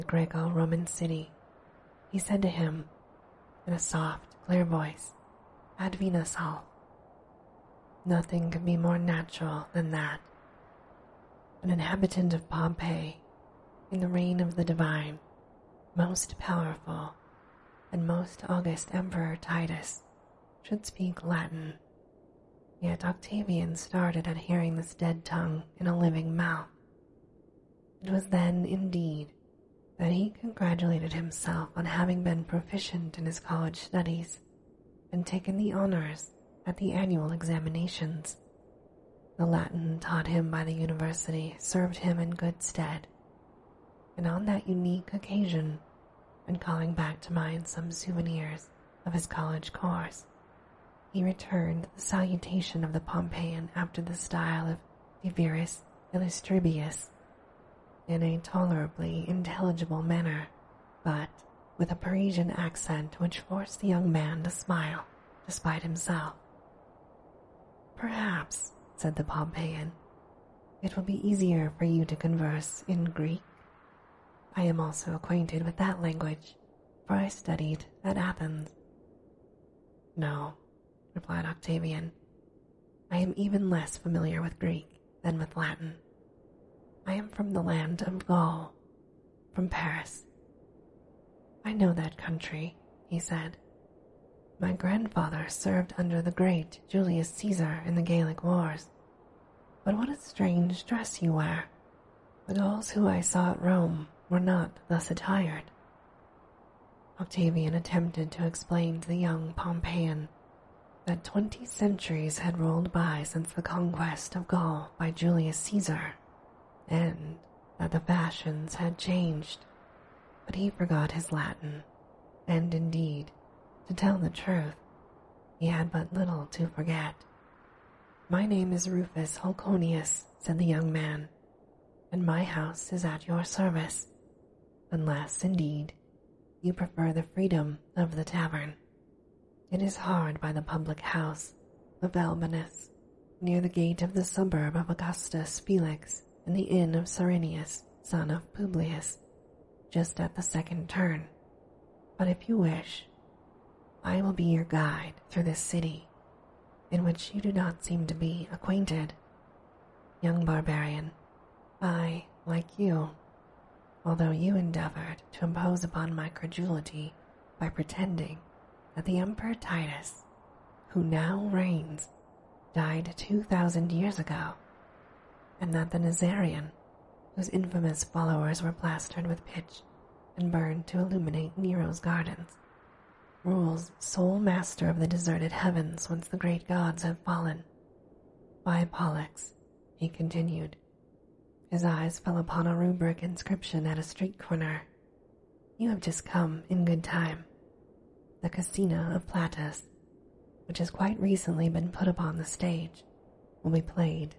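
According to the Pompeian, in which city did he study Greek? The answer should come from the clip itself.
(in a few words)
Athens.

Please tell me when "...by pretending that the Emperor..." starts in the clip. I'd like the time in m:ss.
2:47.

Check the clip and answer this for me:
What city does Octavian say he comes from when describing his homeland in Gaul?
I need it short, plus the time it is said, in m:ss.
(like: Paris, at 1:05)
Paris, at 1:29.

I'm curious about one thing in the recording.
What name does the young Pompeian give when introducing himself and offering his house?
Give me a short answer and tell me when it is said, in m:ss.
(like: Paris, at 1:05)
Rufus Holconius, at 2:08.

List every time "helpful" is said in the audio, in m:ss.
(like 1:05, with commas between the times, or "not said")
not said.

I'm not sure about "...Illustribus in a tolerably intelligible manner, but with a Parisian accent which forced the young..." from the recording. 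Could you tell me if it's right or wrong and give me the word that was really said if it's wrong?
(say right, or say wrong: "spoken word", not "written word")
right.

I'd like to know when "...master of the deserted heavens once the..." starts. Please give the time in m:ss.
3:04.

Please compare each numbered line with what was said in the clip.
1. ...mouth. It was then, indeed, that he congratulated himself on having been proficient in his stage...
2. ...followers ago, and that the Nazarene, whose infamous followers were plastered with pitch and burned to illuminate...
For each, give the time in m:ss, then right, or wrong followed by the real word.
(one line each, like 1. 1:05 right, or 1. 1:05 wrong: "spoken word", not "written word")
1. 0:26 wrong: "college", not "stage"
2. 2:53 wrong: "years", not "followers".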